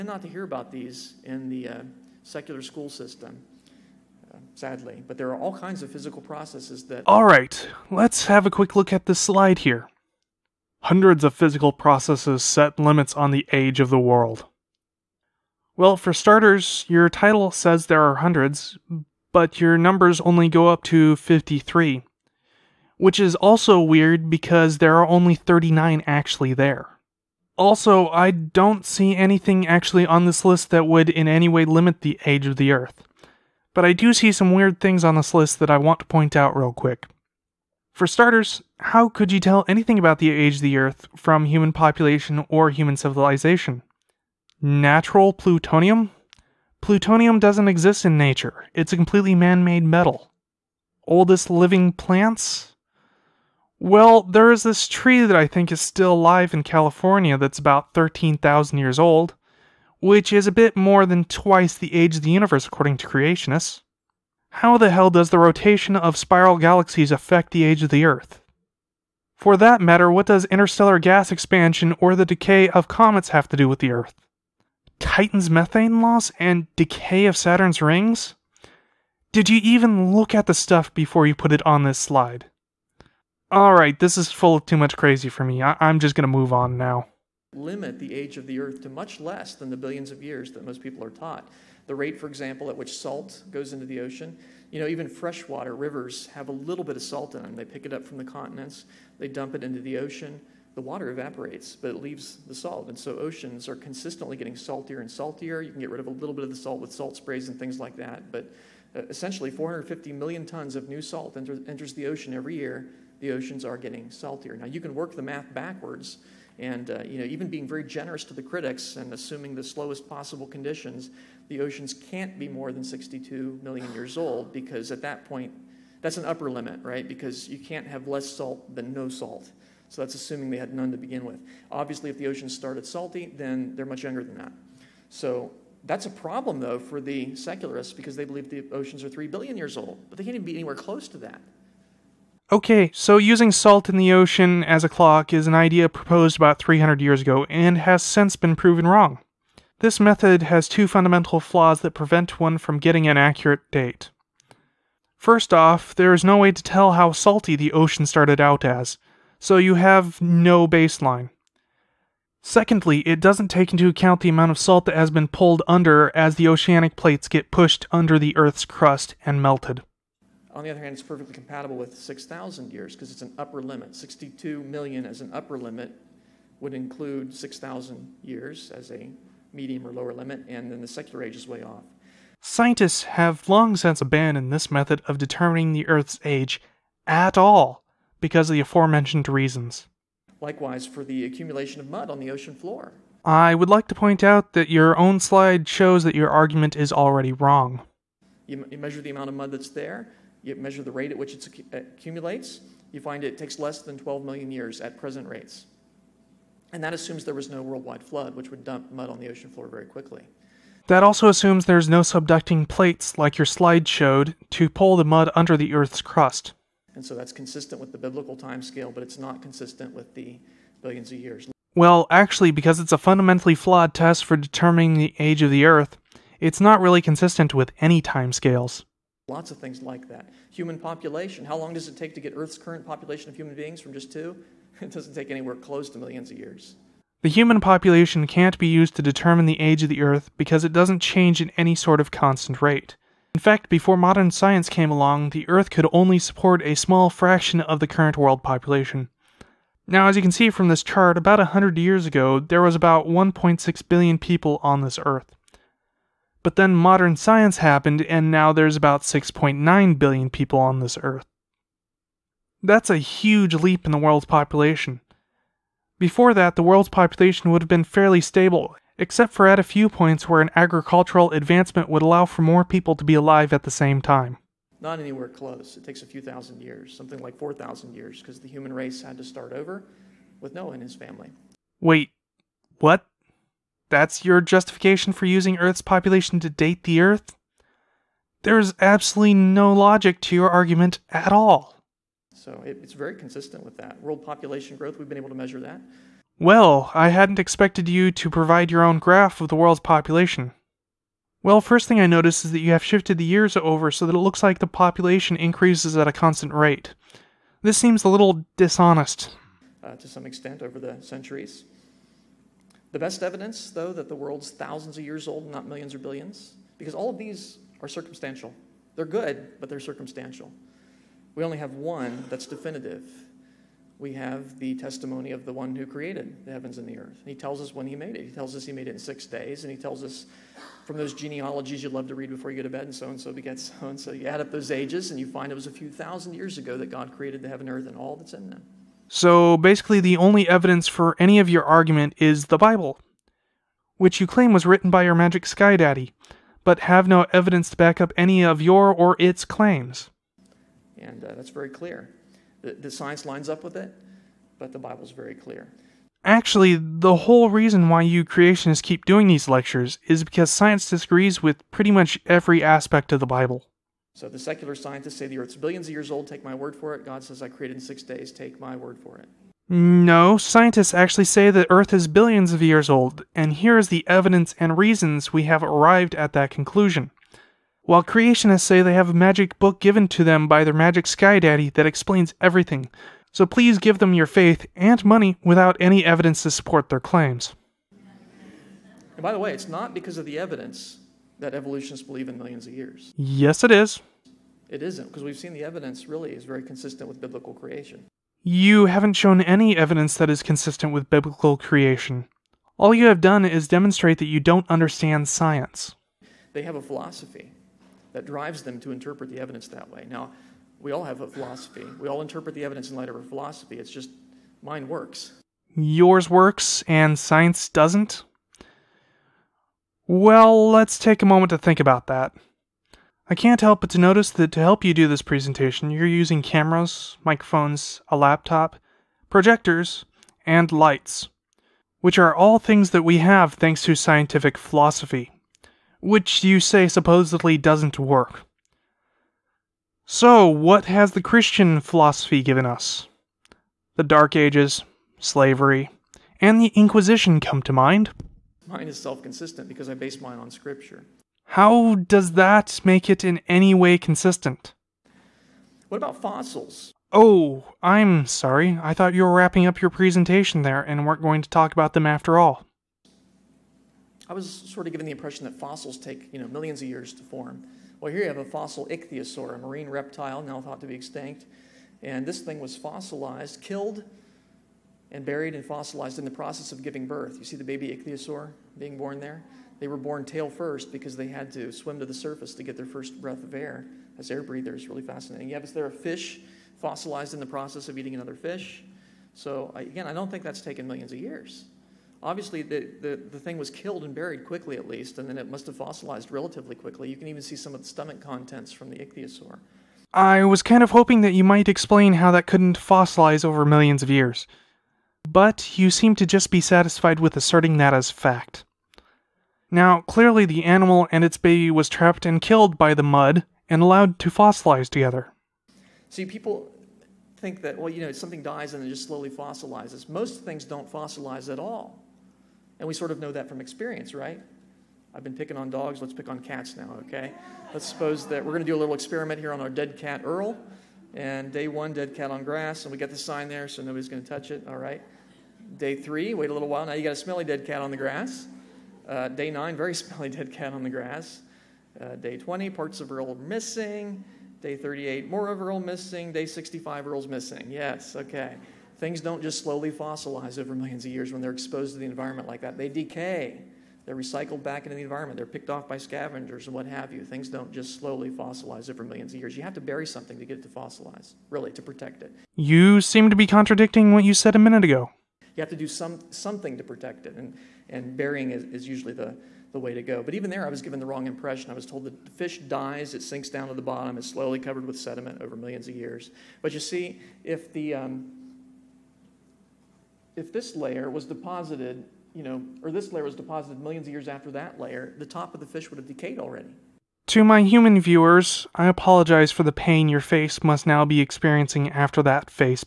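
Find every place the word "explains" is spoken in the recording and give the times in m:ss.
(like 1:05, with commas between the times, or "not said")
6:21, 8:21.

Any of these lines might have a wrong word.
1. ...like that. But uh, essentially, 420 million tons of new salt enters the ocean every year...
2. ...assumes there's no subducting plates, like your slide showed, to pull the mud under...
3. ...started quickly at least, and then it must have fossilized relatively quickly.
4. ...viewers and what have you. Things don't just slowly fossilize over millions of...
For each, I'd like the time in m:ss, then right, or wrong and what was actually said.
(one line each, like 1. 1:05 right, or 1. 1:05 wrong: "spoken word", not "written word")
1. 1:47 wrong: "450", not "420"
2. 3:31 right
3. 8:14 wrong: "buried", not "started"
4. 9:15 wrong: "scavengers", not "viewers".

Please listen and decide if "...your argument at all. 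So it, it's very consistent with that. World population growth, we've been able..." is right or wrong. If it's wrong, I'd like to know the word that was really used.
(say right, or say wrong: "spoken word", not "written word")
right.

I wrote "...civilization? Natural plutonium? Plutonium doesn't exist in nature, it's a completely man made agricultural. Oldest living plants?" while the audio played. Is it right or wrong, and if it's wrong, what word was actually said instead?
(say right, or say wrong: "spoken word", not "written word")
wrong: "metal", not "agricultural".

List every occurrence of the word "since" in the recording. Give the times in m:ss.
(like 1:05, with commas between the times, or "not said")
2:28, 3:03.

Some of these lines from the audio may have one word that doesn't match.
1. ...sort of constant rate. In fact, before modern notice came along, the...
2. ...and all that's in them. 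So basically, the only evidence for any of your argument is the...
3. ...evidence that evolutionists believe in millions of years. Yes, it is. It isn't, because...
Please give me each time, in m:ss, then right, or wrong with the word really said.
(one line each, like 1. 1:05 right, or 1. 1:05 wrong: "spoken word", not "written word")
1. 4:01 wrong: "science", not "notice"
2. 5:37 right
3. 6:30 right.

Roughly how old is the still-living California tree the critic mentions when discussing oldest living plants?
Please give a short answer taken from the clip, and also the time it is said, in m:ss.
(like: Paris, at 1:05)
13,000 years, at 0:57.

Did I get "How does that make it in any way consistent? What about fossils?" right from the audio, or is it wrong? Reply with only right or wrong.
right.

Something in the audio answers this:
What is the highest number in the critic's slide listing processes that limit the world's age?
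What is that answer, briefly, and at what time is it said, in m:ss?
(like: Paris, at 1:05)
53, at 0:21.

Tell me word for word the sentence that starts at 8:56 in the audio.
Now you got a smelly dead cat on the grass.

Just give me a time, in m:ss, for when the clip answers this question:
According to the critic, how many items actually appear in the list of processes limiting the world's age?
0:25.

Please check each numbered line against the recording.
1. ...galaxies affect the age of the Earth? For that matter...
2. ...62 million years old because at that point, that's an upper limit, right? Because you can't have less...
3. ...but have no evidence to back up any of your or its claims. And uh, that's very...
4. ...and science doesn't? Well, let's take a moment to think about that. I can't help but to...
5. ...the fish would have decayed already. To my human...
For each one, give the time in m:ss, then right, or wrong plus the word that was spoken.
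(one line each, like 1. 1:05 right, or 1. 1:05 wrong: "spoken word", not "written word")
1. 1:06 right
2. 2:02 right
3. 5:46 right
4. 6:56 right
5. 9:45 right.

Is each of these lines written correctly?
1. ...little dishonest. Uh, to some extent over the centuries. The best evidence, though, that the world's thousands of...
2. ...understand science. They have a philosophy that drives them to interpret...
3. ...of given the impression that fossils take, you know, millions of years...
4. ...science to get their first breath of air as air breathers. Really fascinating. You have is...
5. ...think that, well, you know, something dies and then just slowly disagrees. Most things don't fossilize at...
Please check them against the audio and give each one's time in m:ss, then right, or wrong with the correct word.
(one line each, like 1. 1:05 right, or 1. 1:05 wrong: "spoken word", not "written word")
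1. 5:08 right
2. 6:44 right
3. 7:44 right
4. 8:02 wrong: "surface", not "science"
5. 8:37 wrong: "fossilizes", not "disagrees".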